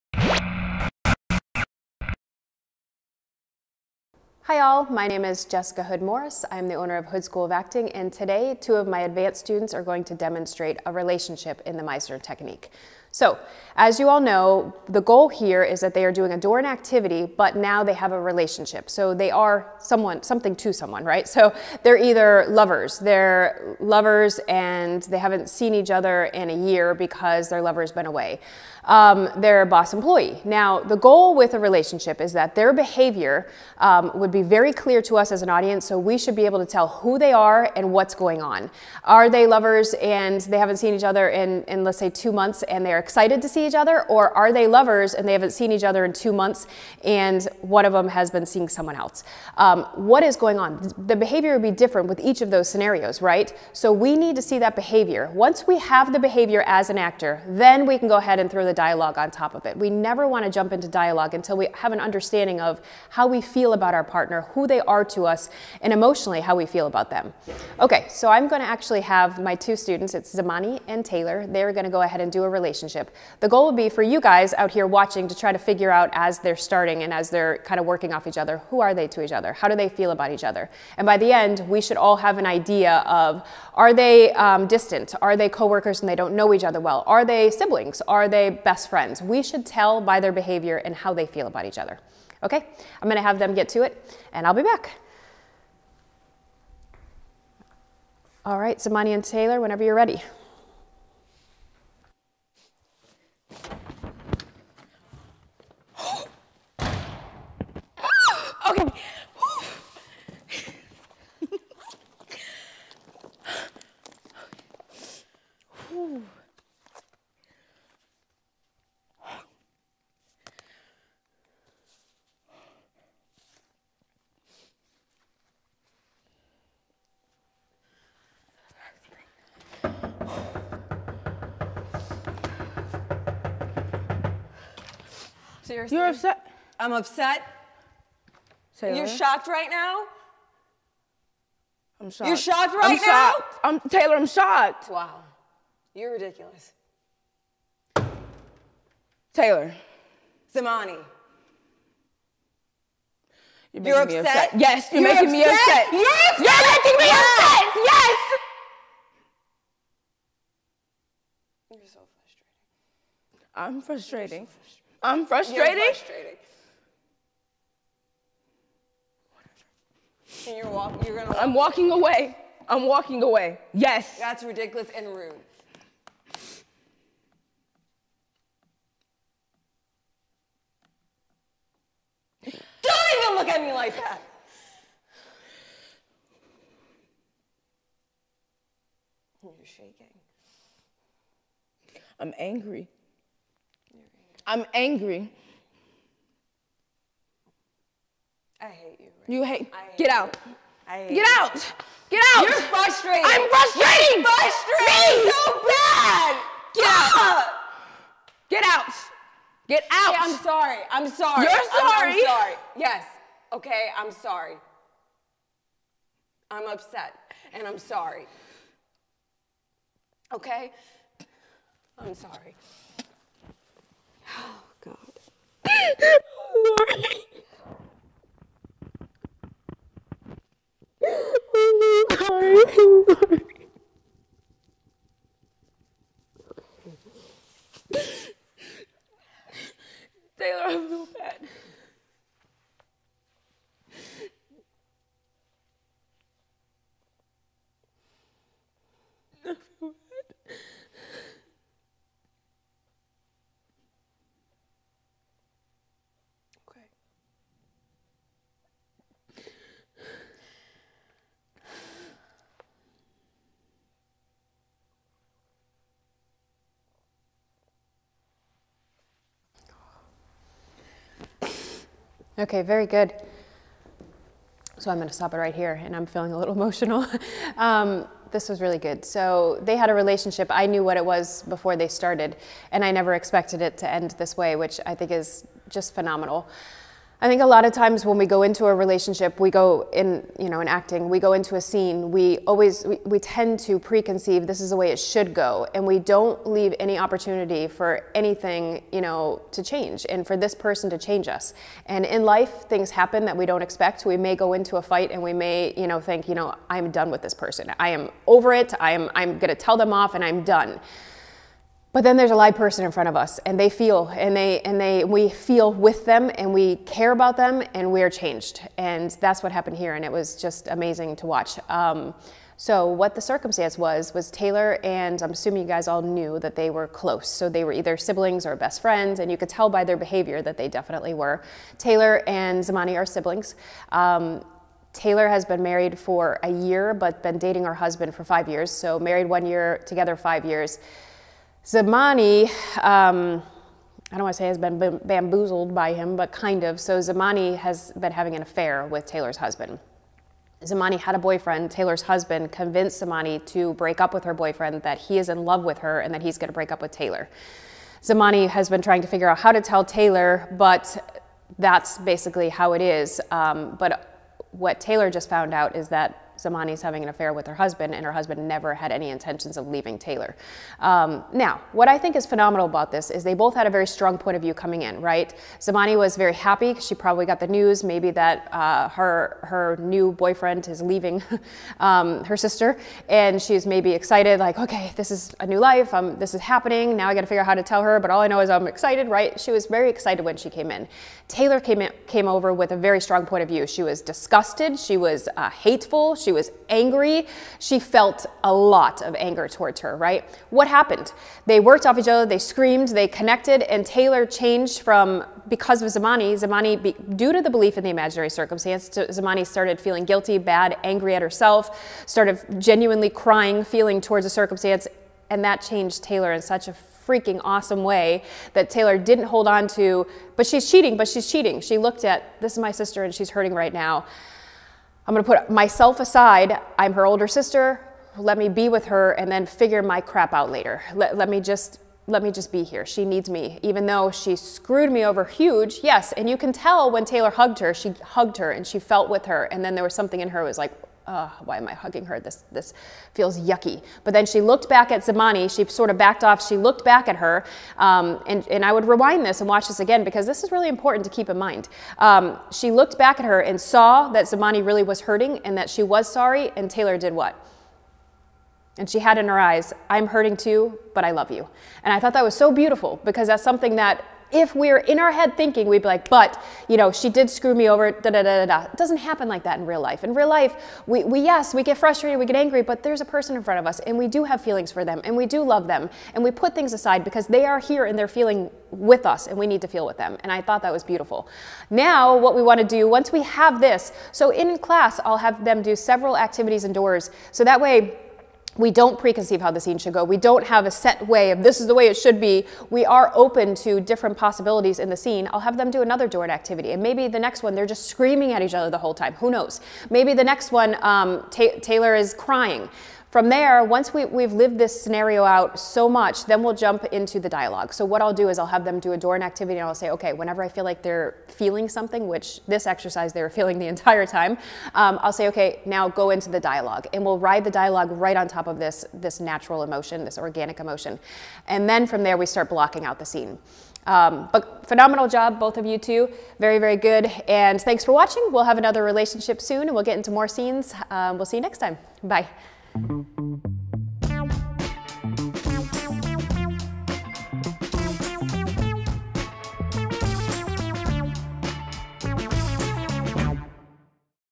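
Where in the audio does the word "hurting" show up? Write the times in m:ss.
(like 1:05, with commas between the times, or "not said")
7:03, 7:35, 7:40.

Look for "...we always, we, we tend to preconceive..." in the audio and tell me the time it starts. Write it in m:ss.
4:52.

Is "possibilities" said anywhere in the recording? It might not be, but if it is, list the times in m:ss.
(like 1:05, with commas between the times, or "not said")
8:14.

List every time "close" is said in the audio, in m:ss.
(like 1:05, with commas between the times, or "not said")
5:26.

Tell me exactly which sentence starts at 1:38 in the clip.
All right, Zamani and Taylor, whenever you're ready.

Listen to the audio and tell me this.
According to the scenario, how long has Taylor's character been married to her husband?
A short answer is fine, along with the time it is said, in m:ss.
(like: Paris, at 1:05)
1 year, at 5:35.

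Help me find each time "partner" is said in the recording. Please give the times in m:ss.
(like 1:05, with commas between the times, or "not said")
1:04.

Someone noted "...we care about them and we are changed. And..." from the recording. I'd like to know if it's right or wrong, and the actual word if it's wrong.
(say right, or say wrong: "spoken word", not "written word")
right.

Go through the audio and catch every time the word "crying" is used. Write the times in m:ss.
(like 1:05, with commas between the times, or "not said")
6:53, 8:22.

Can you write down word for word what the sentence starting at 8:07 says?
So that way, we don't preconceive how the scene should go.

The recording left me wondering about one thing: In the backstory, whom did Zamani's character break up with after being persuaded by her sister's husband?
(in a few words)
her boyfriend.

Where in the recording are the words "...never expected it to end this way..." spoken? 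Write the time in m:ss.
4:42.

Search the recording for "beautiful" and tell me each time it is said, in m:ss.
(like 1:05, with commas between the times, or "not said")
7:42, 8:00.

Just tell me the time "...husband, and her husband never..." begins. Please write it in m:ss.
6:07.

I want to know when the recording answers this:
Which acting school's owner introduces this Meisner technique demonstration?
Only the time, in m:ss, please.
0:07.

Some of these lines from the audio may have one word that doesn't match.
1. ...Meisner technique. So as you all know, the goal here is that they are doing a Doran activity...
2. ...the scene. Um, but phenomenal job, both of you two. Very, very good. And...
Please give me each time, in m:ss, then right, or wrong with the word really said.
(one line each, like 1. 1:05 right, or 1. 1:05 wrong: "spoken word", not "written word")
1. 0:11 right
2. 8:42 right.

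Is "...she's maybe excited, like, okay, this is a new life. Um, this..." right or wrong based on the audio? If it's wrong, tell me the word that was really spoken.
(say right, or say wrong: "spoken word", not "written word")
right.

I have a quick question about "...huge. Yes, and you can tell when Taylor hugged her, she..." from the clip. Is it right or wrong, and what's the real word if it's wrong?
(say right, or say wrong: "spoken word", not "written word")
right.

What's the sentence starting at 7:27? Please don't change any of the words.
Um, and, and I would rewind this and watch this again because this is really important to keep in mind.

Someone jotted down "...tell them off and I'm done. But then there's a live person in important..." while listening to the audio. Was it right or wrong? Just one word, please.
wrong.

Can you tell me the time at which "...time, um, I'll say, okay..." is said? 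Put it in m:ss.
8:34.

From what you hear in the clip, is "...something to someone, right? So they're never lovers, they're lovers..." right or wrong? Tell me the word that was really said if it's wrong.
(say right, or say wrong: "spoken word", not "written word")
wrong: "either", not "never".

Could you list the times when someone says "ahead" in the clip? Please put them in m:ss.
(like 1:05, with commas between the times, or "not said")
0:58, 1:12.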